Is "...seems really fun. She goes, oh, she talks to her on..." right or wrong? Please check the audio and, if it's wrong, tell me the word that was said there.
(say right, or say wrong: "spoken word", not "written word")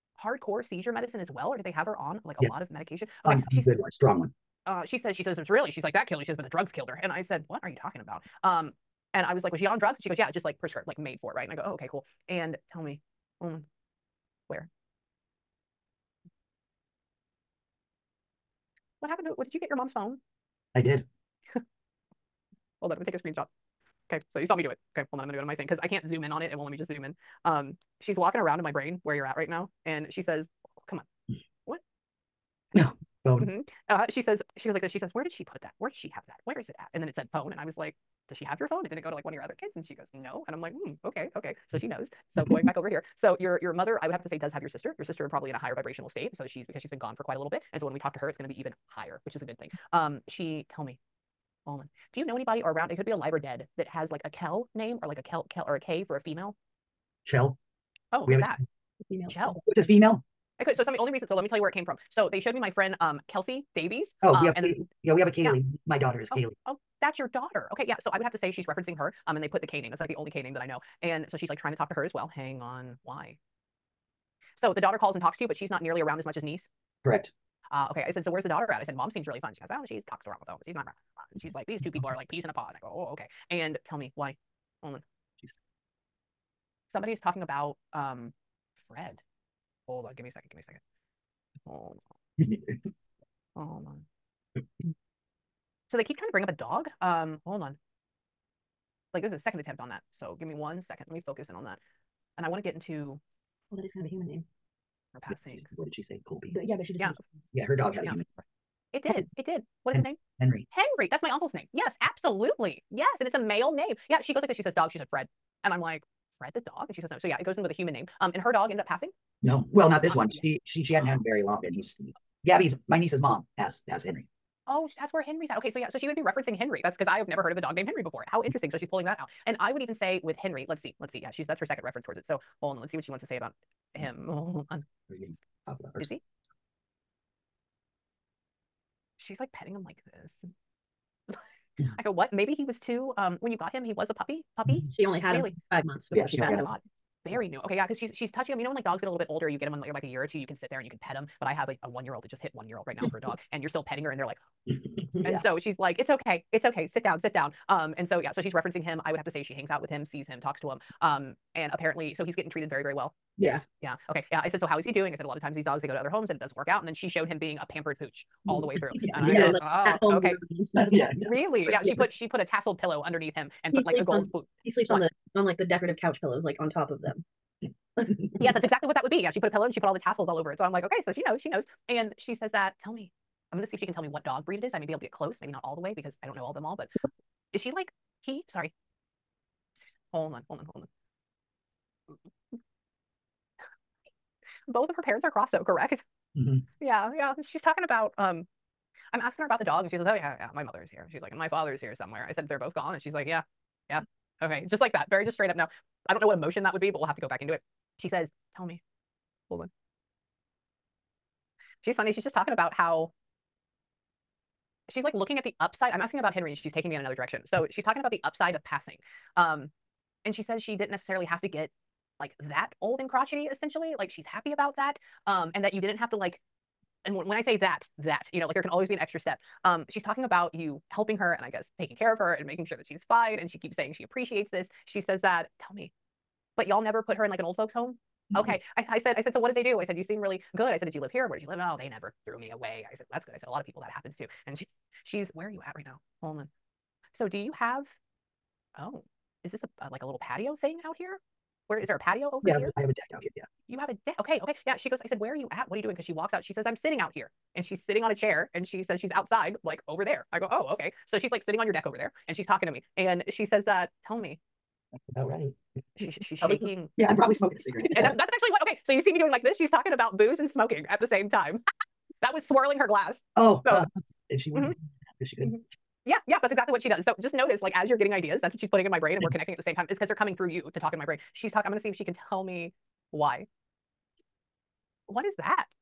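right.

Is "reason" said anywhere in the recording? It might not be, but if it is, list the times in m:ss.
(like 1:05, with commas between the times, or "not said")
1:01.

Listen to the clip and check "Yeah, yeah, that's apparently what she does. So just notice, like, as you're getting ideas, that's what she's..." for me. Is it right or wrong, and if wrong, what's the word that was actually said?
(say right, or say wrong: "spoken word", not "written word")
wrong: "exactly", not "apparently".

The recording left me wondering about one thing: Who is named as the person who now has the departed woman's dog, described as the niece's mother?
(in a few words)
Gabby.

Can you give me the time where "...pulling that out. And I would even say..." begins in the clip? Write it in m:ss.
2:08.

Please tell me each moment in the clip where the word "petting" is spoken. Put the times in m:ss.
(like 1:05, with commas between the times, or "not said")
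2:19, 2:33.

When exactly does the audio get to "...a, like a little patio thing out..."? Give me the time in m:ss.
4:09.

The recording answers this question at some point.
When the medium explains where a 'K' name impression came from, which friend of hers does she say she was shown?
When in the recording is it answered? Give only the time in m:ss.
1:03.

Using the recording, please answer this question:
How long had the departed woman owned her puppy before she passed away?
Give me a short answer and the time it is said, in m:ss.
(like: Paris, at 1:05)
5 months, at 2:25.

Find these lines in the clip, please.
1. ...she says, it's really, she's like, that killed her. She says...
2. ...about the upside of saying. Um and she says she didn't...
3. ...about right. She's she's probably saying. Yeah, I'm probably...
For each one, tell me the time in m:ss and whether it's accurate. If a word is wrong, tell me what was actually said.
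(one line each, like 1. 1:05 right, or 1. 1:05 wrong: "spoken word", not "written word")
1. 0:05 right
2. 3:37 wrong: "passing", not "saying"
3. 4:25 wrong: "shaking", not "saying".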